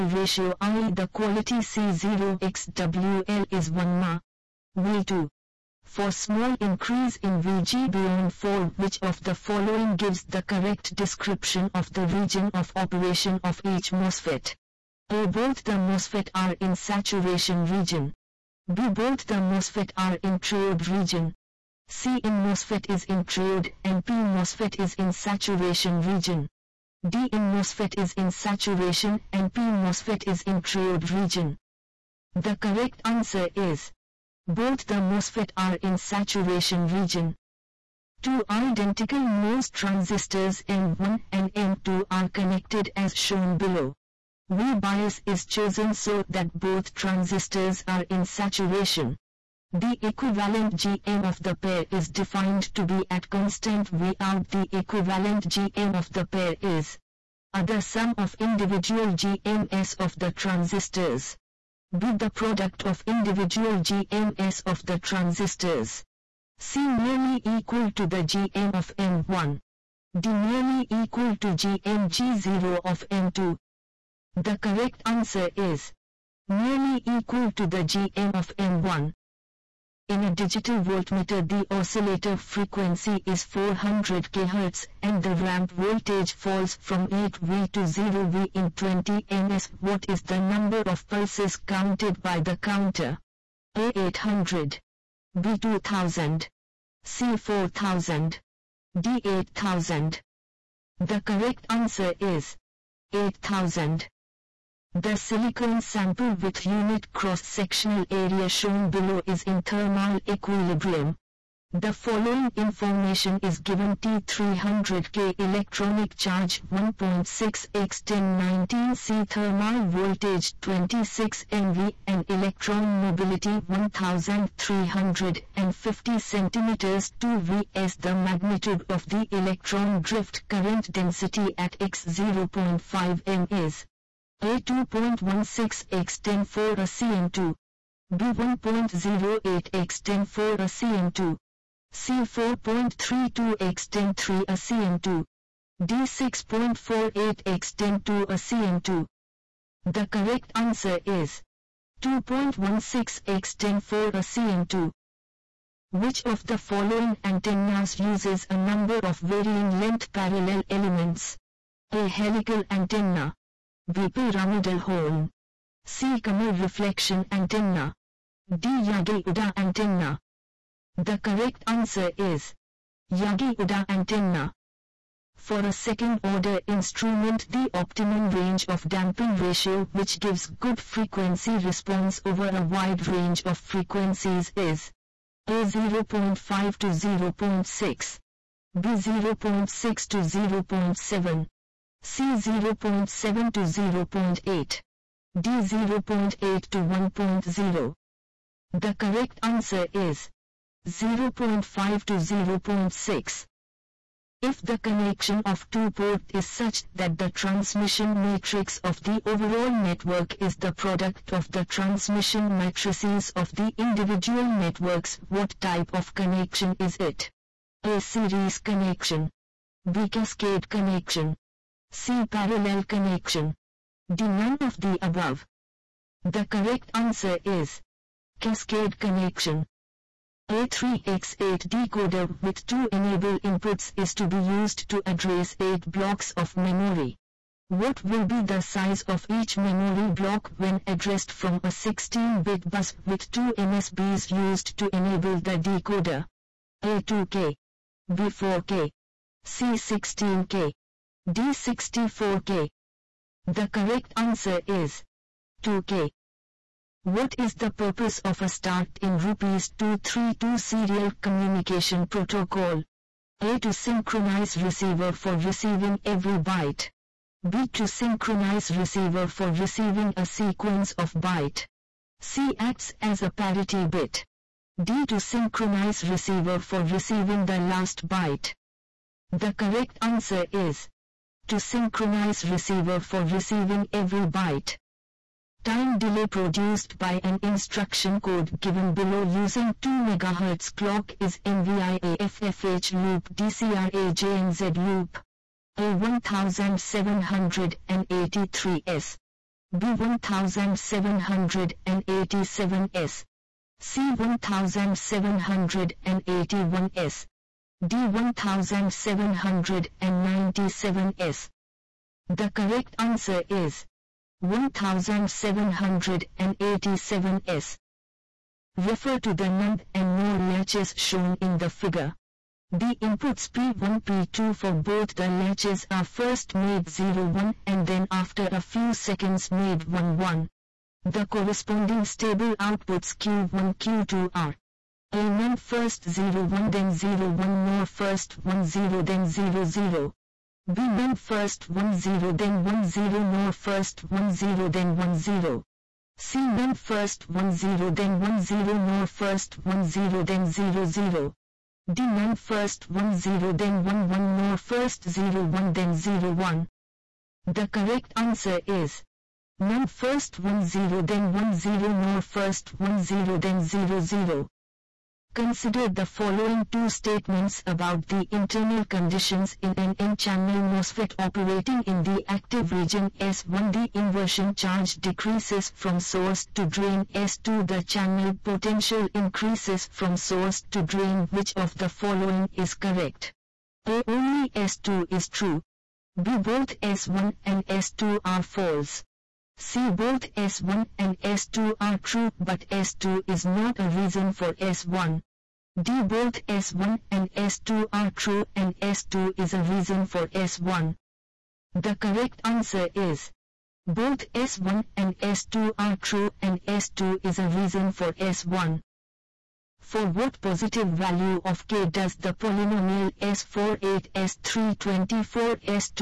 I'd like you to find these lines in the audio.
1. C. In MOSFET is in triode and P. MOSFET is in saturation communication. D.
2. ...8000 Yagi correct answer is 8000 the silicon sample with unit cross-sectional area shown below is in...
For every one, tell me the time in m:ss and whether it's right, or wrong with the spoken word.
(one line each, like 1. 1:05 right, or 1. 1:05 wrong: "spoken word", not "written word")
1. 0:21 wrong: "region", not "communication"
2. 1:39 wrong: "The", not "Yagi".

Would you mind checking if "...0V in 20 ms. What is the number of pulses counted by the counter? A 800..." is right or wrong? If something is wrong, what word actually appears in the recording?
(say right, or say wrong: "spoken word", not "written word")
right.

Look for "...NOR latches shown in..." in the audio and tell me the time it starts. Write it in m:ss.
5:20.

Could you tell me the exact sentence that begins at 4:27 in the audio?
B to synchronize receiver for receiving a sequence of byte.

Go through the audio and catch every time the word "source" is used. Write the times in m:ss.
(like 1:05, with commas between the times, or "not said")
6:16, 6:20.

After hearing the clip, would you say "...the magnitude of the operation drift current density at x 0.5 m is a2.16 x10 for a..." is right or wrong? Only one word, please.
wrong.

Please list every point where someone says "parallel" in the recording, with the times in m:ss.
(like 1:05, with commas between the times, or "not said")
2:40, 3:42.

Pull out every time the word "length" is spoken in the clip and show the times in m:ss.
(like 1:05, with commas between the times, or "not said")
2:39.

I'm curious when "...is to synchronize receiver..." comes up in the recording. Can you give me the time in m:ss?
4:40.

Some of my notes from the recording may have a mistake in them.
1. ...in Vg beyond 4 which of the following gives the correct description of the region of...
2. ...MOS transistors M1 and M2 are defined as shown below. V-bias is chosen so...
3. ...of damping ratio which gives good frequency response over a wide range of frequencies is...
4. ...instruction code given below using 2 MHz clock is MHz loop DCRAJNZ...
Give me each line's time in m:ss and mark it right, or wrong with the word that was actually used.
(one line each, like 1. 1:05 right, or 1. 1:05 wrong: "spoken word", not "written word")
1. 0:07 right
2. 0:39 wrong: "connected", not "defined"
3. 2:58 right
4. 4:47 wrong: "MVIAFFH", not "MHz".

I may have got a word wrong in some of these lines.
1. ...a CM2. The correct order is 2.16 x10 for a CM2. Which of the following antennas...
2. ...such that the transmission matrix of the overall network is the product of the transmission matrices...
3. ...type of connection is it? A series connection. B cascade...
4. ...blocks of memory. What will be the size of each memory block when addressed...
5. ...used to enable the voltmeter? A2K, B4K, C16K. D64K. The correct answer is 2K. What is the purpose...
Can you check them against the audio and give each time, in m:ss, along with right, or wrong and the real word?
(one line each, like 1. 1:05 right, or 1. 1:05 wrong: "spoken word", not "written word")
1. 2:28 wrong: "answer", not "order"
2. 3:26 right
3. 3:35 right
4. 3:55 right
5. 4:04 wrong: "decoder", not "voltmeter".